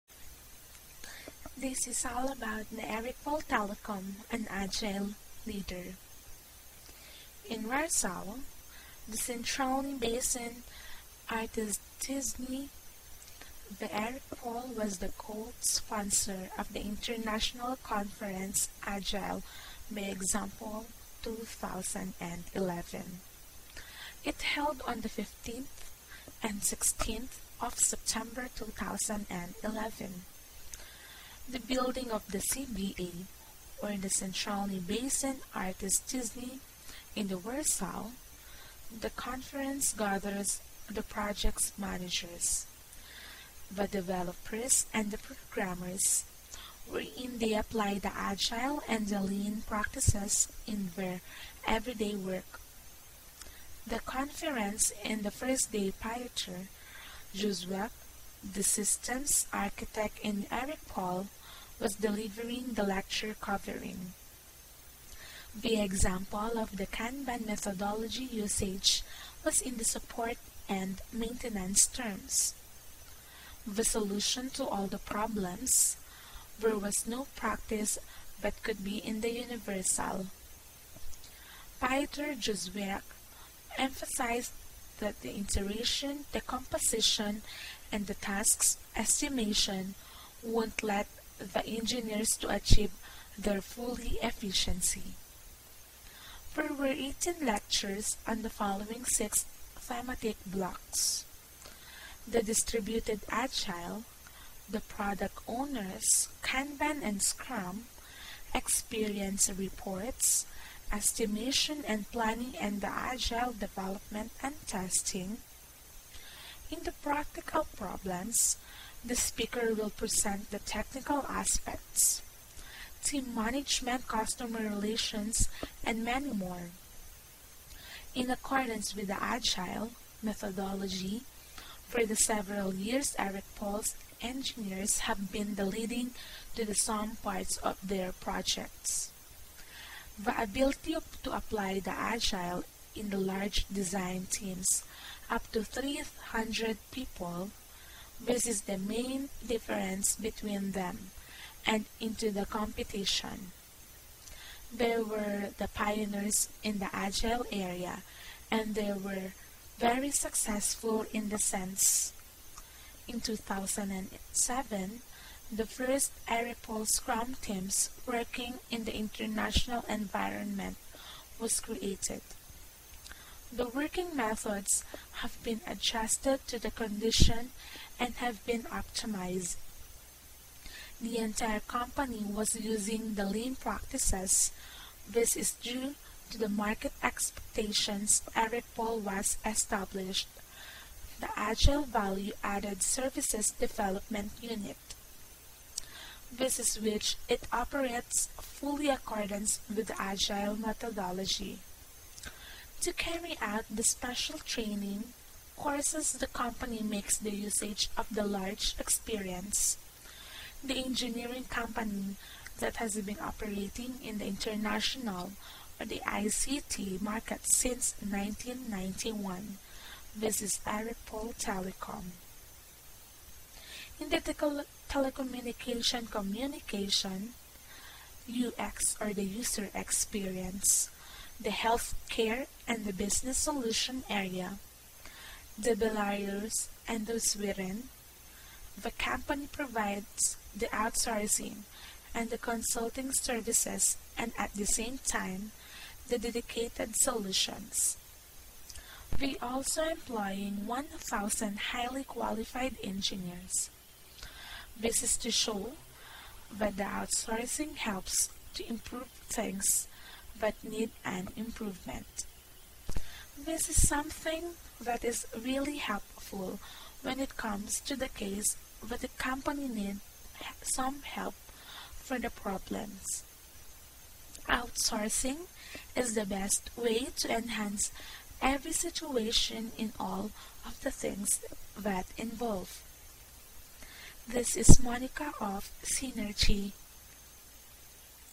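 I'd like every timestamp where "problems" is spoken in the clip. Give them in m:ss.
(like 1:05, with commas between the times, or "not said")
1:14, 1:57, 4:32.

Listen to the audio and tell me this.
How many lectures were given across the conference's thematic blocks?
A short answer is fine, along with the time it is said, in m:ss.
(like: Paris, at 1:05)
18, at 1:36.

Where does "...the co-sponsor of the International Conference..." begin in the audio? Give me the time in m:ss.
0:14.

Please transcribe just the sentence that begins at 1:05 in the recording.
The example of the Kanban methodology usage was in the support and maintenance terms.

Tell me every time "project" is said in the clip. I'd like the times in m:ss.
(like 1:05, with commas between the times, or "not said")
0:41, 2:18.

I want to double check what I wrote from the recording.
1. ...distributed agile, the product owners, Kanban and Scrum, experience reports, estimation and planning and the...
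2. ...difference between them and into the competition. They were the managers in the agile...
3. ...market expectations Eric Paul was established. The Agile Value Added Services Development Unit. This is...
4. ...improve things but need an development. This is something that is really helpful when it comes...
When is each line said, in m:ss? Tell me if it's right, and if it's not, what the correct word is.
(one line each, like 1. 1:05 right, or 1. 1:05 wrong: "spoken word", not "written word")
1. 1:42 right
2. 2:29 wrong: "pioneers", not "managers"
3. 3:06 right
4. 4:18 wrong: "improvement", not "development".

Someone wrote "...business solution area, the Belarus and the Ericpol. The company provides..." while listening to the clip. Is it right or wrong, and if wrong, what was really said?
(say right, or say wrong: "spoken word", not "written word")
wrong: "Sweden", not "Ericpol".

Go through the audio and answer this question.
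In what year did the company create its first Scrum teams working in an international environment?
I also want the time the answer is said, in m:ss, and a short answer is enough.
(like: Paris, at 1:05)
2007, at 2:43.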